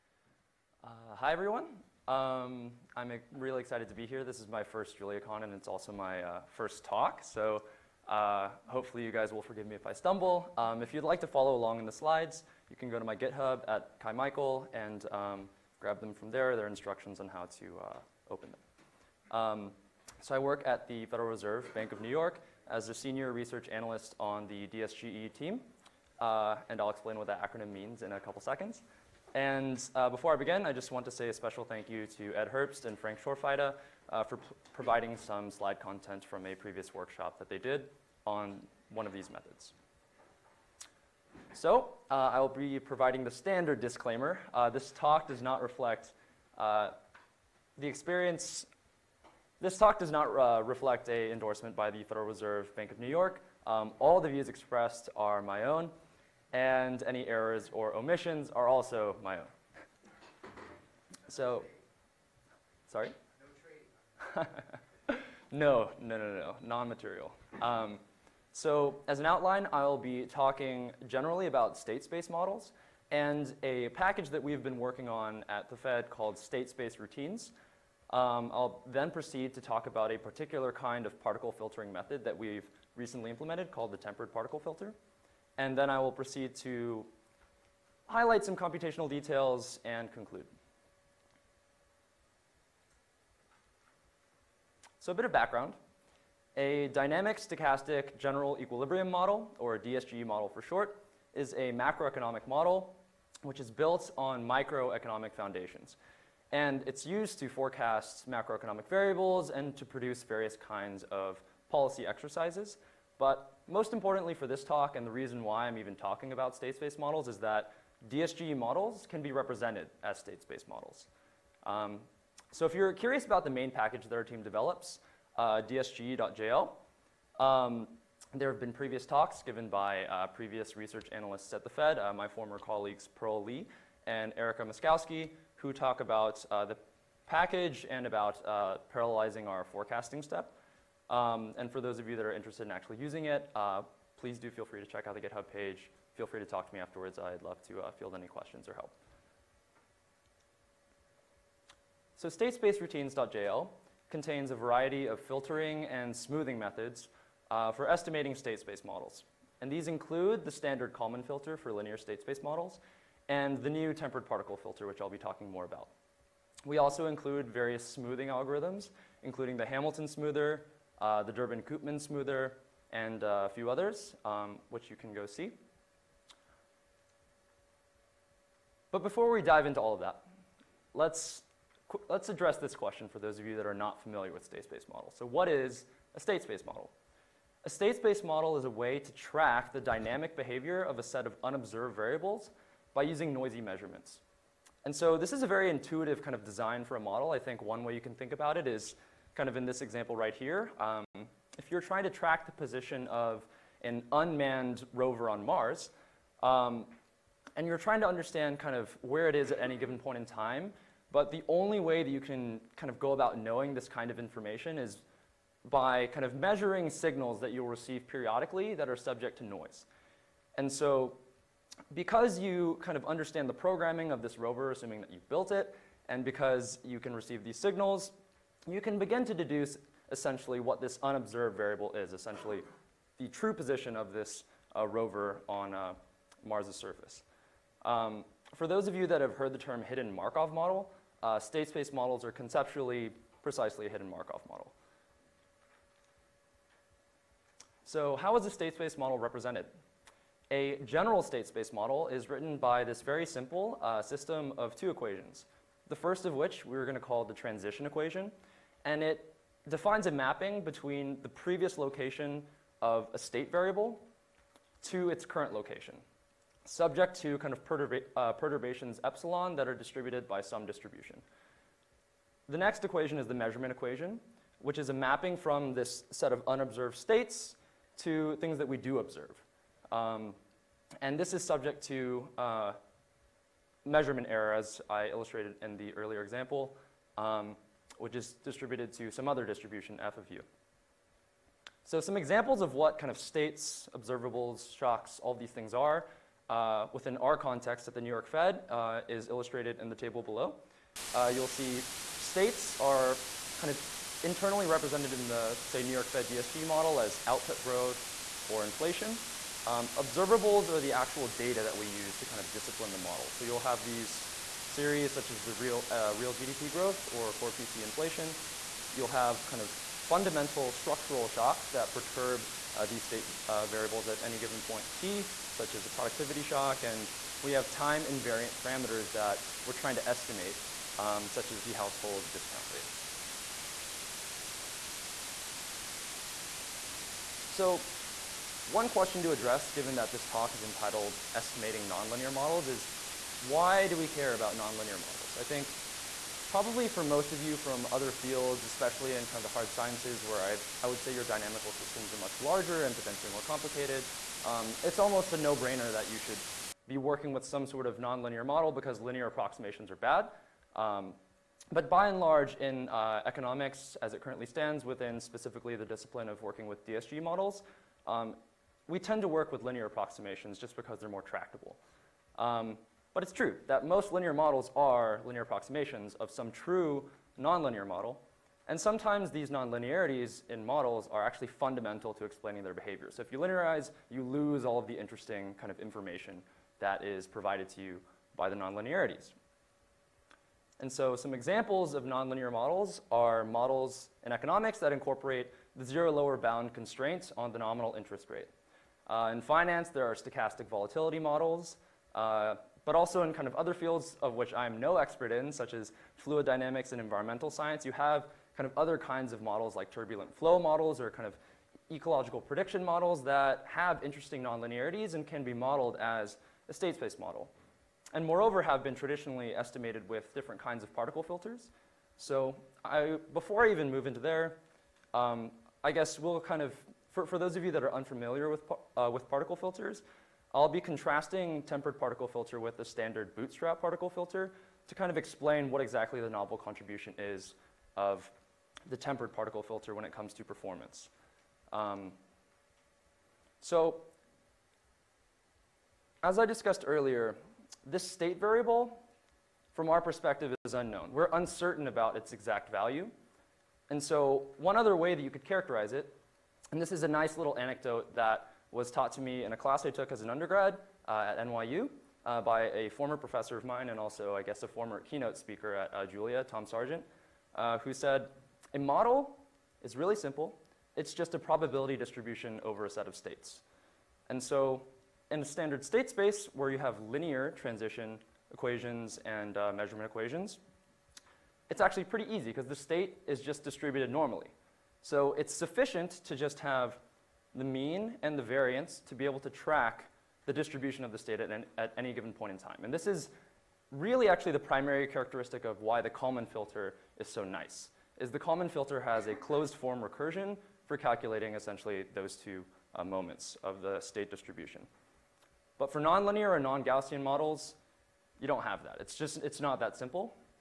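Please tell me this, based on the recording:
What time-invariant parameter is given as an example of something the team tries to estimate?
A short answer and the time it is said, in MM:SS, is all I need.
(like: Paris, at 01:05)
household discount rate, at 05:31.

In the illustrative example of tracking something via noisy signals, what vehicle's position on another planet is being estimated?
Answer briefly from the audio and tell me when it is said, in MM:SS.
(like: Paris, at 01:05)
an unmanned rover, at 03:24.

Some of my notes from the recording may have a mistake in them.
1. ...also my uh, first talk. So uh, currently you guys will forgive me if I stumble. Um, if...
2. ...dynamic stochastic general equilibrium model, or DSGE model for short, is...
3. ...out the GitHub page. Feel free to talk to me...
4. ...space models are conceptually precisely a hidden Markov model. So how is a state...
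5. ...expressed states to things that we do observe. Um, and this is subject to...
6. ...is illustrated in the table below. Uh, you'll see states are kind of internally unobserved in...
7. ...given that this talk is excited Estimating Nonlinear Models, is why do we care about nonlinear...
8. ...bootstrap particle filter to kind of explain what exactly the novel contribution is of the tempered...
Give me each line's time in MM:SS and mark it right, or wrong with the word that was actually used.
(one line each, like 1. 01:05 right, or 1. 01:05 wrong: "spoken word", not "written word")
1. 00:05 wrong: "hopefully", not "currently"
2. 01:36 right
3. 02:25 right
4. 04:01 right
5. 04:36 wrong: "unobserved", not "expressed"
6. 04:59 wrong: "represented", not "unobserved"
7. 05:39 wrong: "entitled", not "excited"
8. 07:13 right.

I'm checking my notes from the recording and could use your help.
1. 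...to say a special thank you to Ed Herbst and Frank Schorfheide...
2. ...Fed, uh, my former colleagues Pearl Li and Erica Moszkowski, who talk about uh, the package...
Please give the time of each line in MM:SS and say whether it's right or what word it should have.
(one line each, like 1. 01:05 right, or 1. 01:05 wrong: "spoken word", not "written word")
1. 00:31 right
2. 02:11 right.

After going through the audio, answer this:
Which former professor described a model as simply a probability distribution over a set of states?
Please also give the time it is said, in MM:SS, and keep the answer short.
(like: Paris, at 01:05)
Tom Sargent, at 07:46.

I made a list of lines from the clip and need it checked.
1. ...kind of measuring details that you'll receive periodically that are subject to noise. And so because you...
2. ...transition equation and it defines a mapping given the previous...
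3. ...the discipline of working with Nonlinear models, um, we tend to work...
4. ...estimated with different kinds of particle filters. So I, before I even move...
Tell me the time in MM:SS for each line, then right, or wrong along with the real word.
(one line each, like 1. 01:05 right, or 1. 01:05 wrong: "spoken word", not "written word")
1. 03:36 wrong: "signals", not "details"
2. 04:17 wrong: "between", not "given"
3. 06:05 wrong: "DSGE", not "Nonlinear"
4. 06:59 right.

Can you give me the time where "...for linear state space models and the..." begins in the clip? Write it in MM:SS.
02:41.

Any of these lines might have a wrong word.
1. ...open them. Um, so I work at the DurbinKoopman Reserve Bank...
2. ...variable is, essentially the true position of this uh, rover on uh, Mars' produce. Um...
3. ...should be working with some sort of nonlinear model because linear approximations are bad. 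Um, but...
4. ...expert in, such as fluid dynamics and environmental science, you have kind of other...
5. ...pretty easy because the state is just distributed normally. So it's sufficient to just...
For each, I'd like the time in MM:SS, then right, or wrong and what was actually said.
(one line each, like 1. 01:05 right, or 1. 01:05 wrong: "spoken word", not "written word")
1. 00:18 wrong: "Federal", not "DurbinKoopman"
2. 03:51 wrong: "surface", not "produce"
3. 05:56 right
4. 06:44 right
5. 08:02 right.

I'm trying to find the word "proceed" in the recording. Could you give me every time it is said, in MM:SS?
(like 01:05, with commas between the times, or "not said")
01:19, 01:26.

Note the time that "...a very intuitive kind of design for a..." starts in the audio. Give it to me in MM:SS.
03:15.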